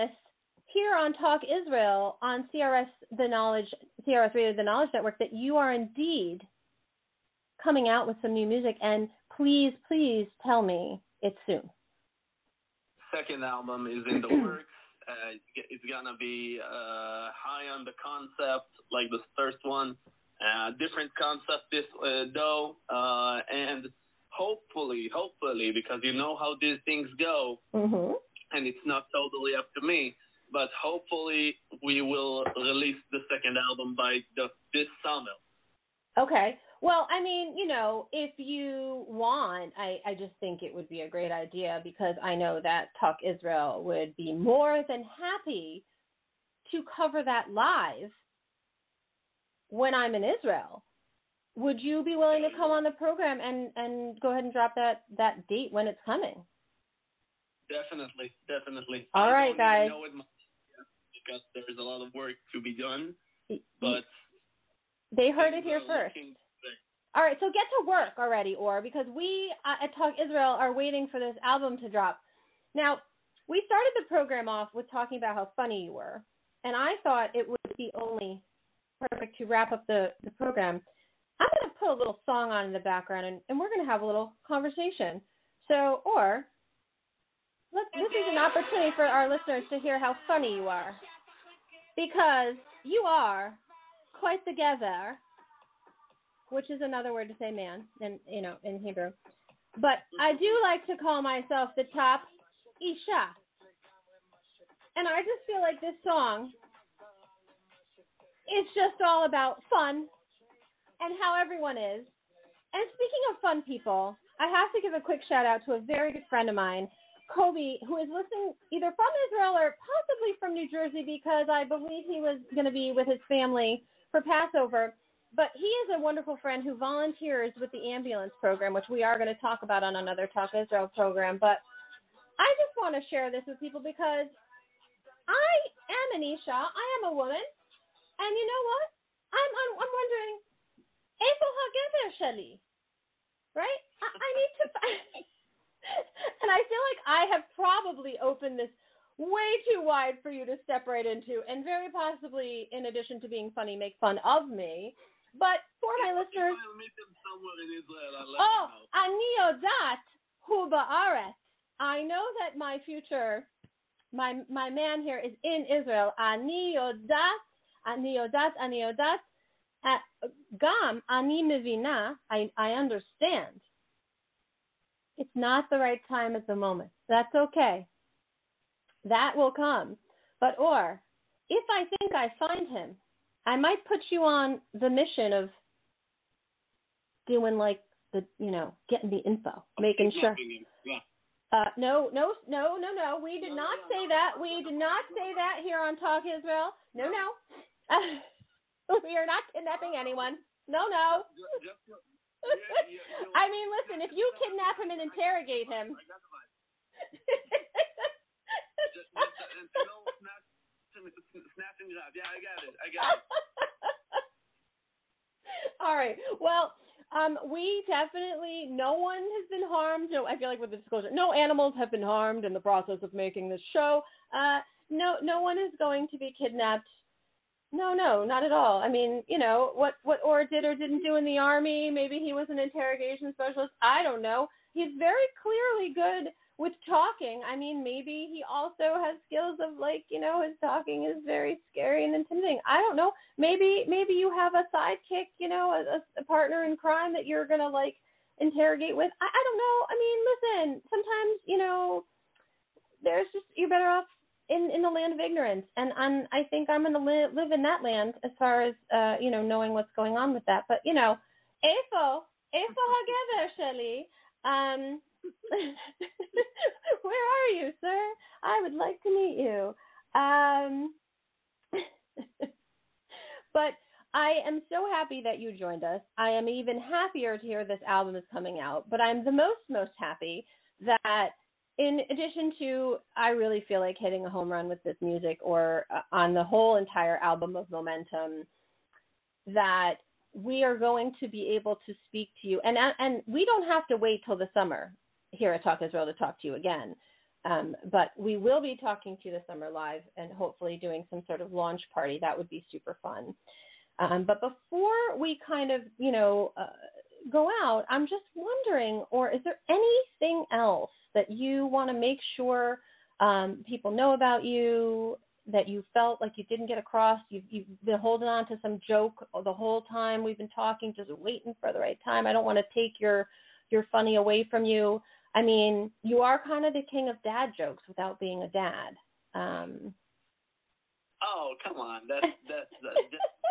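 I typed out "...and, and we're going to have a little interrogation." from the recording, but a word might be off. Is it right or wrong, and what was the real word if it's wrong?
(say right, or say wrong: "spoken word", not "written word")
wrong: "conversation", not "interrogation".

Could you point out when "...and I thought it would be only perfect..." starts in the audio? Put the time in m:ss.
1:16.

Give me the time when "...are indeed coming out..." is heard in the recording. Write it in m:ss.
0:05.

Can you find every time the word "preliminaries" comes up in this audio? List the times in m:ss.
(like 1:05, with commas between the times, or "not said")
not said.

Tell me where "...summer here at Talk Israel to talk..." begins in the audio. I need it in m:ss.
4:54.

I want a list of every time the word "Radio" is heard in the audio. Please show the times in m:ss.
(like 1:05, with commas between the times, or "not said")
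0:04.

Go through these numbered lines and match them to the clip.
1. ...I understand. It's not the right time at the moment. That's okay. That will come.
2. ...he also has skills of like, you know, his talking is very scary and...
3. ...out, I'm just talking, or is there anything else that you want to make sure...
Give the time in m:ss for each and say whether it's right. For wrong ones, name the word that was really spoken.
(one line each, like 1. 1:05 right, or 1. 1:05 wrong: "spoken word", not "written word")
1. 2:52 right
2. 3:58 right
3. 5:07 wrong: "wondering", not "talking".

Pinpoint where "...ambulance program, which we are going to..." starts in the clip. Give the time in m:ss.
2:07.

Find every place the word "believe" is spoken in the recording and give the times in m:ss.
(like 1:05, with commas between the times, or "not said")
2:01.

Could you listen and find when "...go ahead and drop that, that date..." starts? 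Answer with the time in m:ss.
0:54.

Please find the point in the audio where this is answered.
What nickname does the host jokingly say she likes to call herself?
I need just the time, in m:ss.
1:41.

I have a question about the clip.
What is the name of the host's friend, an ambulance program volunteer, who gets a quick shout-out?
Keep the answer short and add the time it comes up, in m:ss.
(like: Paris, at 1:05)
Kobe, at 1:57.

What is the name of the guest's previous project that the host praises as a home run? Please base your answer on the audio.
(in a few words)
Momentum.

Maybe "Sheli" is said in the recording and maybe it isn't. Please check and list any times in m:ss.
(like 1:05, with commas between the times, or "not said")
2:22, 4:23.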